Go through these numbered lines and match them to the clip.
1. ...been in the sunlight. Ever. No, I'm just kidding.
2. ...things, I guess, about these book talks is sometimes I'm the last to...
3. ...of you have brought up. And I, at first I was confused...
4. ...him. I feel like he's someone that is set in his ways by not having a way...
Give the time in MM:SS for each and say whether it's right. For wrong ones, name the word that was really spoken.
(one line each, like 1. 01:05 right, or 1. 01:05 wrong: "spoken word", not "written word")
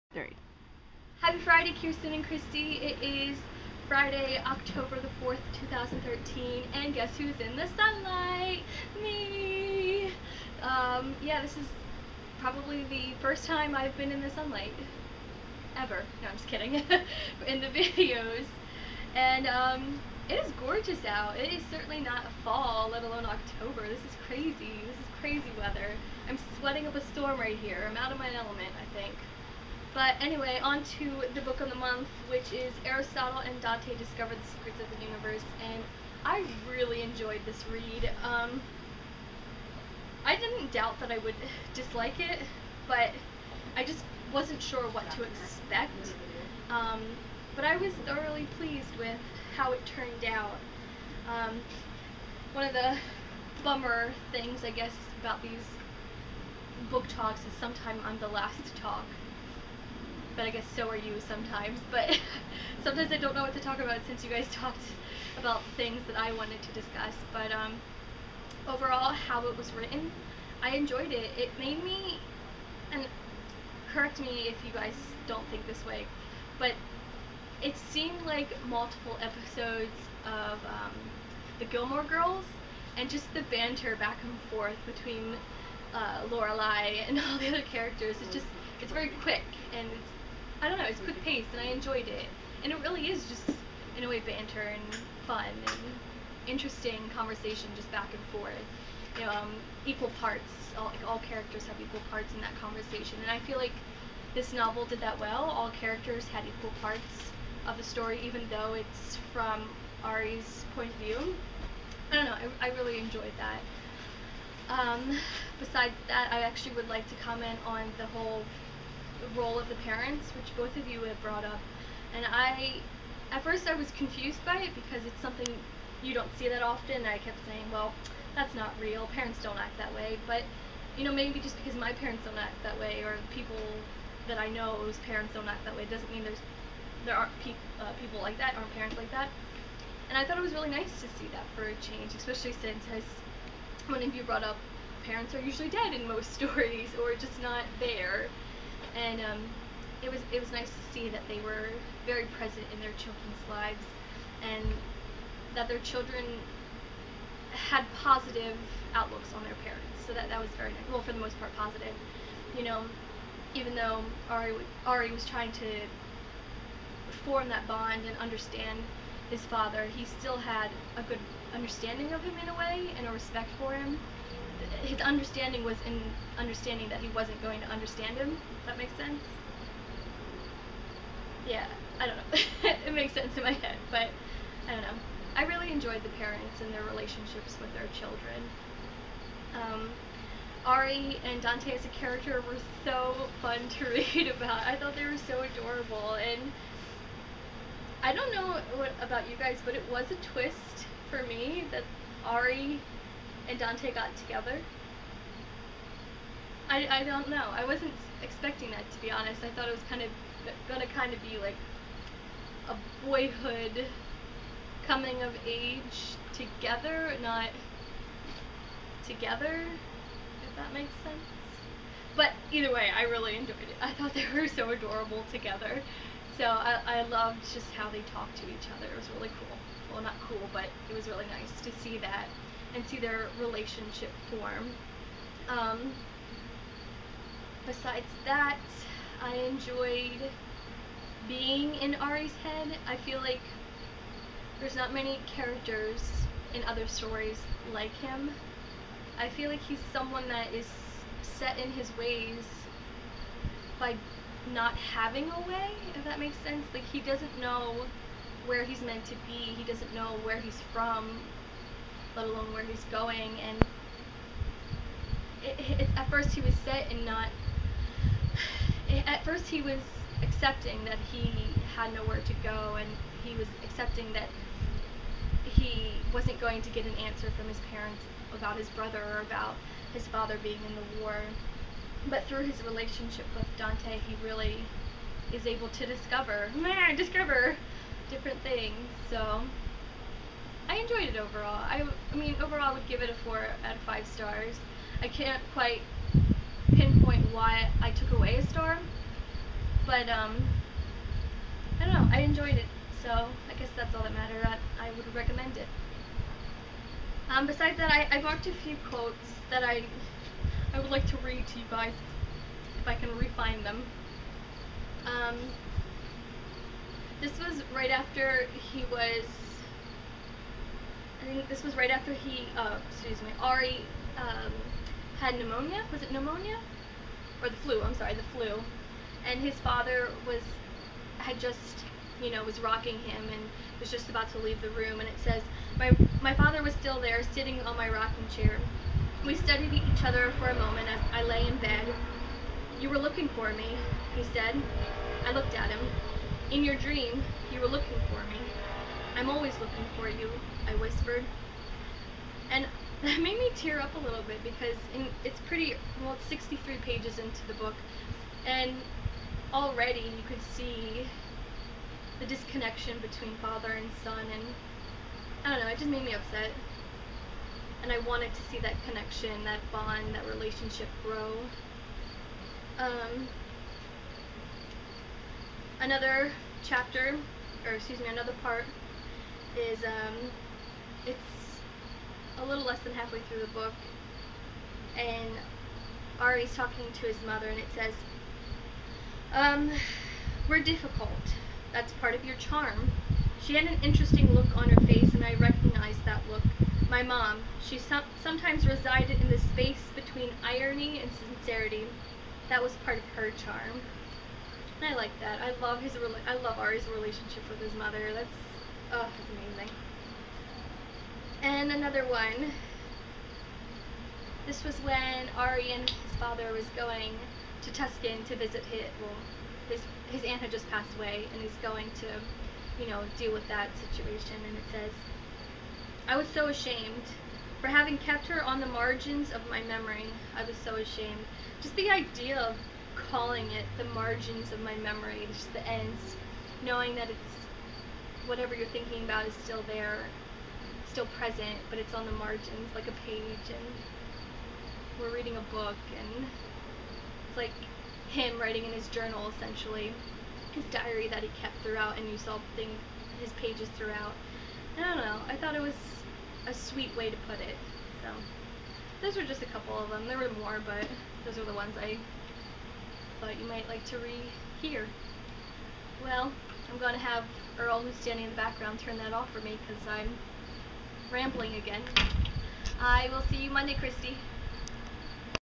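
1. 00:13 right
2. 00:54 right
3. 02:00 right
4. 04:07 right.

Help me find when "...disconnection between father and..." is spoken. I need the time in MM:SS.
06:02.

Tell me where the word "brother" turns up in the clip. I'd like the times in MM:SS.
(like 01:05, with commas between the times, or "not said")
04:38.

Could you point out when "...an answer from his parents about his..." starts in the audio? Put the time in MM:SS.
04:36.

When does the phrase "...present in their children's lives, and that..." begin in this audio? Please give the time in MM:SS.
02:32.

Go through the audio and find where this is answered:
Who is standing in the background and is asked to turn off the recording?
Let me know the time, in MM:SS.
07:47.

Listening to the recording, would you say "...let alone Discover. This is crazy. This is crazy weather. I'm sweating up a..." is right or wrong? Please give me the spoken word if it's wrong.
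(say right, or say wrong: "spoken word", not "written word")
wrong: "October", not "Discover".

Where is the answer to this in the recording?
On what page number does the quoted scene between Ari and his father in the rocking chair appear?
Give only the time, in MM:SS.
05:56.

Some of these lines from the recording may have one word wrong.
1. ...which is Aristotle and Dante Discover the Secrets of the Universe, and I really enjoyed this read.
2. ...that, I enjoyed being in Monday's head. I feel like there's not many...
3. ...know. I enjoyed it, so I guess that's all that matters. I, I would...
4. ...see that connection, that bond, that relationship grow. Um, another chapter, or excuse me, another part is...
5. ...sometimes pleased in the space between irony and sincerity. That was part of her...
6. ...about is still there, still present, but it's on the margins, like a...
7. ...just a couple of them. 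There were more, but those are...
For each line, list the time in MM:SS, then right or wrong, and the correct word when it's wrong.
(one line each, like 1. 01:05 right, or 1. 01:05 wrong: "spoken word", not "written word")
1. 00:32 right
2. 03:58 wrong: "Ari", not "Monday"
3. 05:01 right
4. 06:08 right
5. 06:38 wrong: "resided", not "pleased"
6. 07:19 right
7. 07:39 right.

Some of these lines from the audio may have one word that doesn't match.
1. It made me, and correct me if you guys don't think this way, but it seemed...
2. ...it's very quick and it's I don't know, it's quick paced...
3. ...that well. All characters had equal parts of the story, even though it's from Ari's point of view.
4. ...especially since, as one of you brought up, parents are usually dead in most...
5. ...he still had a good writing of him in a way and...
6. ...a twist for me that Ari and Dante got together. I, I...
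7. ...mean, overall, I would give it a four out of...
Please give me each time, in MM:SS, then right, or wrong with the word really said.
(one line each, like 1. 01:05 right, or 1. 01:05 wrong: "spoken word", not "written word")
1. 01:11 right
2. 01:28 right
3. 01:45 right
4. 02:22 right
5. 02:49 wrong: "understanding", not "writing"
6. 03:20 right
7. 04:52 right.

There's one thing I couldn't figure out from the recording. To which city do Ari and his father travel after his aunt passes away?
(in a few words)
Tucson.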